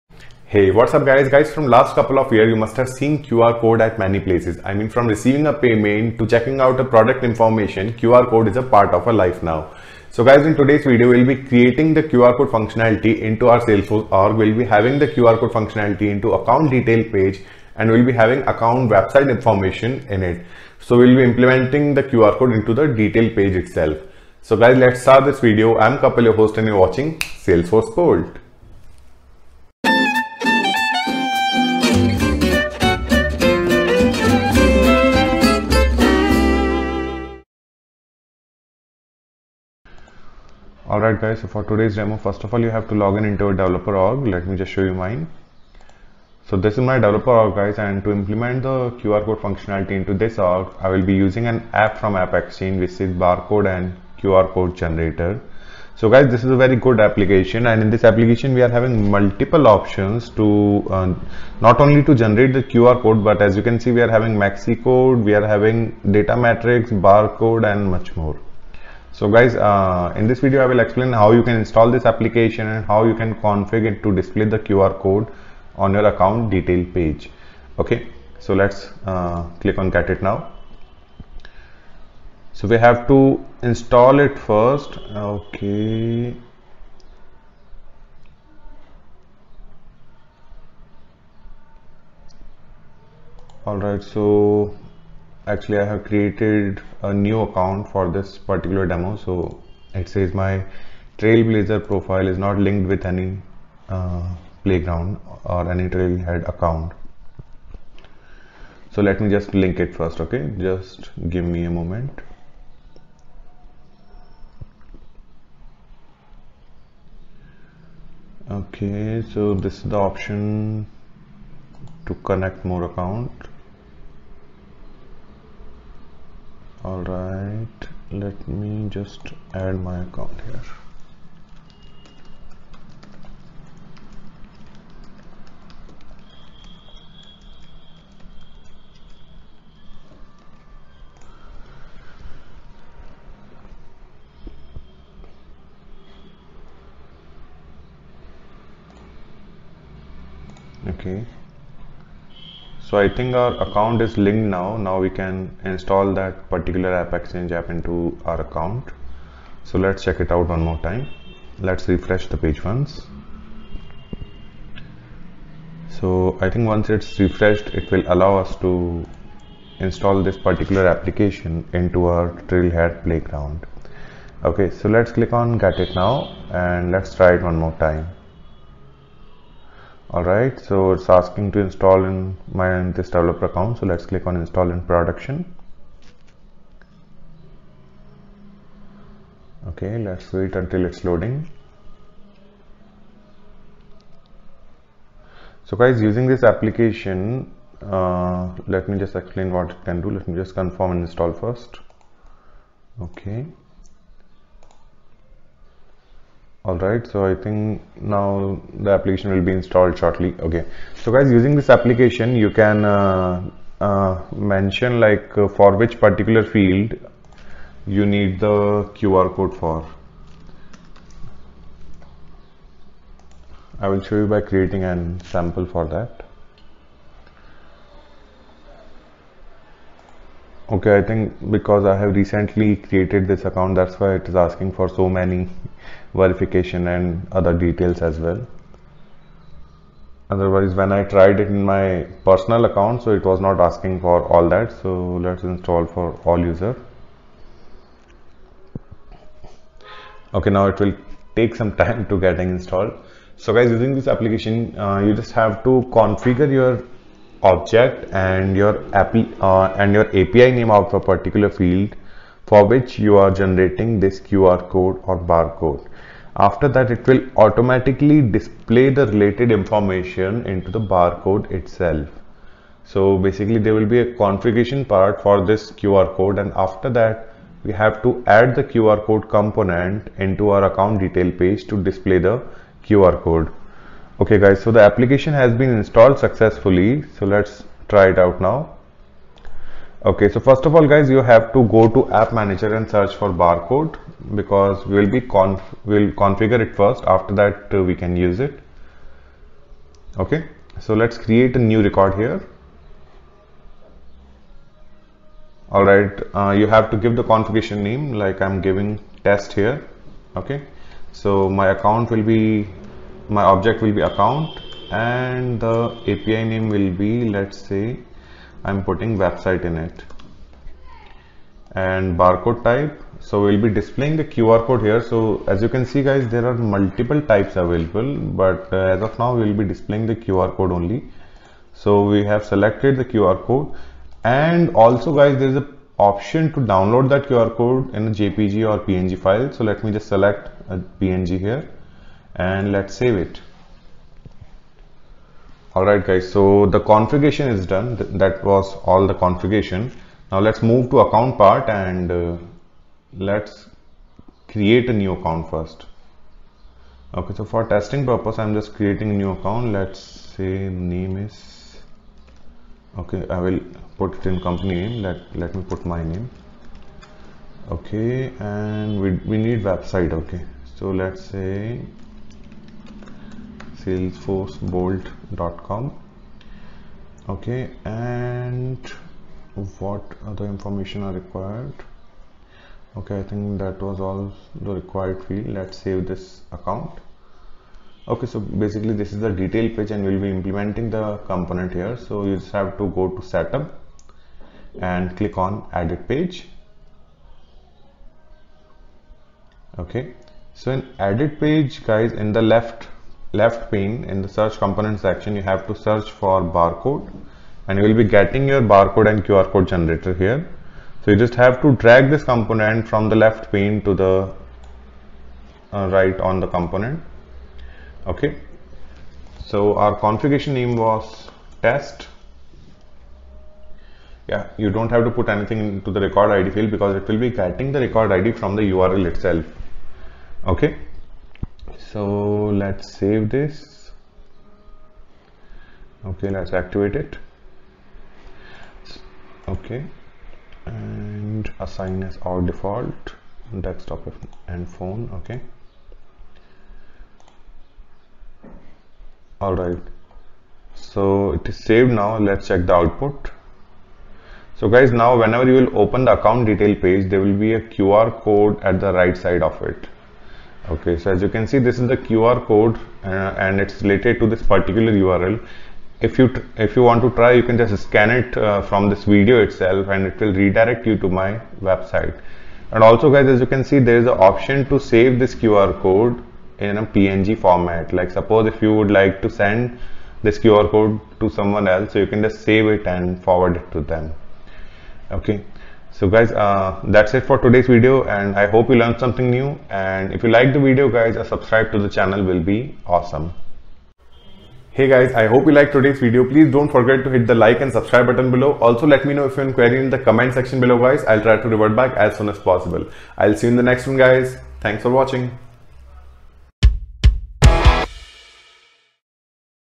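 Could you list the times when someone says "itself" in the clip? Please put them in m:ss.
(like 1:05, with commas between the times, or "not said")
0:23, 4:31, 7:09, 7:49.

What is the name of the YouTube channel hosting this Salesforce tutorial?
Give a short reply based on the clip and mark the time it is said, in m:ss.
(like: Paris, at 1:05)
Salesforce Bolt, at 0:27.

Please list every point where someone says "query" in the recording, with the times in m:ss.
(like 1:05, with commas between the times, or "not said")
8:19.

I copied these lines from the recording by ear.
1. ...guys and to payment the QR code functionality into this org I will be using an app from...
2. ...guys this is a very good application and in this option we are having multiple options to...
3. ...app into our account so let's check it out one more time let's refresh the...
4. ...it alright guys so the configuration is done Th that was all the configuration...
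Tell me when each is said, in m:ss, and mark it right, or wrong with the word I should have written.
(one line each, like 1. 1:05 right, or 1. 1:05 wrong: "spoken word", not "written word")
1. 0:47 wrong: "implement", not "payment"
2. 0:56 wrong: "application", not "option"
3. 2:37 right
4. 5:43 right.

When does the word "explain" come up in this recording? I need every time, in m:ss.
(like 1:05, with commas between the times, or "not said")
1:10, 3:19.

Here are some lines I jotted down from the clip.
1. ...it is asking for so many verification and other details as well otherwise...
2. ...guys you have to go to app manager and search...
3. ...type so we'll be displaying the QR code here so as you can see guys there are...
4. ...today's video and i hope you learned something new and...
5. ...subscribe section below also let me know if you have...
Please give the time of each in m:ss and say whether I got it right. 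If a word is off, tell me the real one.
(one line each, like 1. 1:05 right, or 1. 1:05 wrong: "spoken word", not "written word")
1. 3:54 right
2. 4:50 right
3. 5:22 right
4. 8:07 right
5. 8:17 wrong: "button", not "section".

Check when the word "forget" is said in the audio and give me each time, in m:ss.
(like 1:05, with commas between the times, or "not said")
8:16.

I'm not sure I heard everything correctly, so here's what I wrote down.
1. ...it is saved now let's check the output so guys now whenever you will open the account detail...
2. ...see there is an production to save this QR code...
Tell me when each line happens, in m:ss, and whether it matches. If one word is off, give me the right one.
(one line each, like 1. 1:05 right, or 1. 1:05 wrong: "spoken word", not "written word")
1. 7:31 right
2. 7:53 wrong: "option", not "production".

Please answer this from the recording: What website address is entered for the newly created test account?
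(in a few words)
salesforcebolt.com.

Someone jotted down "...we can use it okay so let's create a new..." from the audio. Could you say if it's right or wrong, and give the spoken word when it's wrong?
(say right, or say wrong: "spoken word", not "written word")
right.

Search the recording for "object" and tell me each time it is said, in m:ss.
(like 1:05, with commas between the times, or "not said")
4:17, 5:13.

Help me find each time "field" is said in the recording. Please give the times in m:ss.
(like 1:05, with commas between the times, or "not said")
3:36, 4:21, 6:25, 7:06.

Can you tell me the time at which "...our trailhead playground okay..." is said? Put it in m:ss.
2:52.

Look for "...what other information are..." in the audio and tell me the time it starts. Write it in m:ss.
6:19.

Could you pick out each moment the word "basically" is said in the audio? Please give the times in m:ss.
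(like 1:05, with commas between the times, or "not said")
4:33, 6:28.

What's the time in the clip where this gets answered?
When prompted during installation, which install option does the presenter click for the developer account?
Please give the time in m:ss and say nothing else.
3:04.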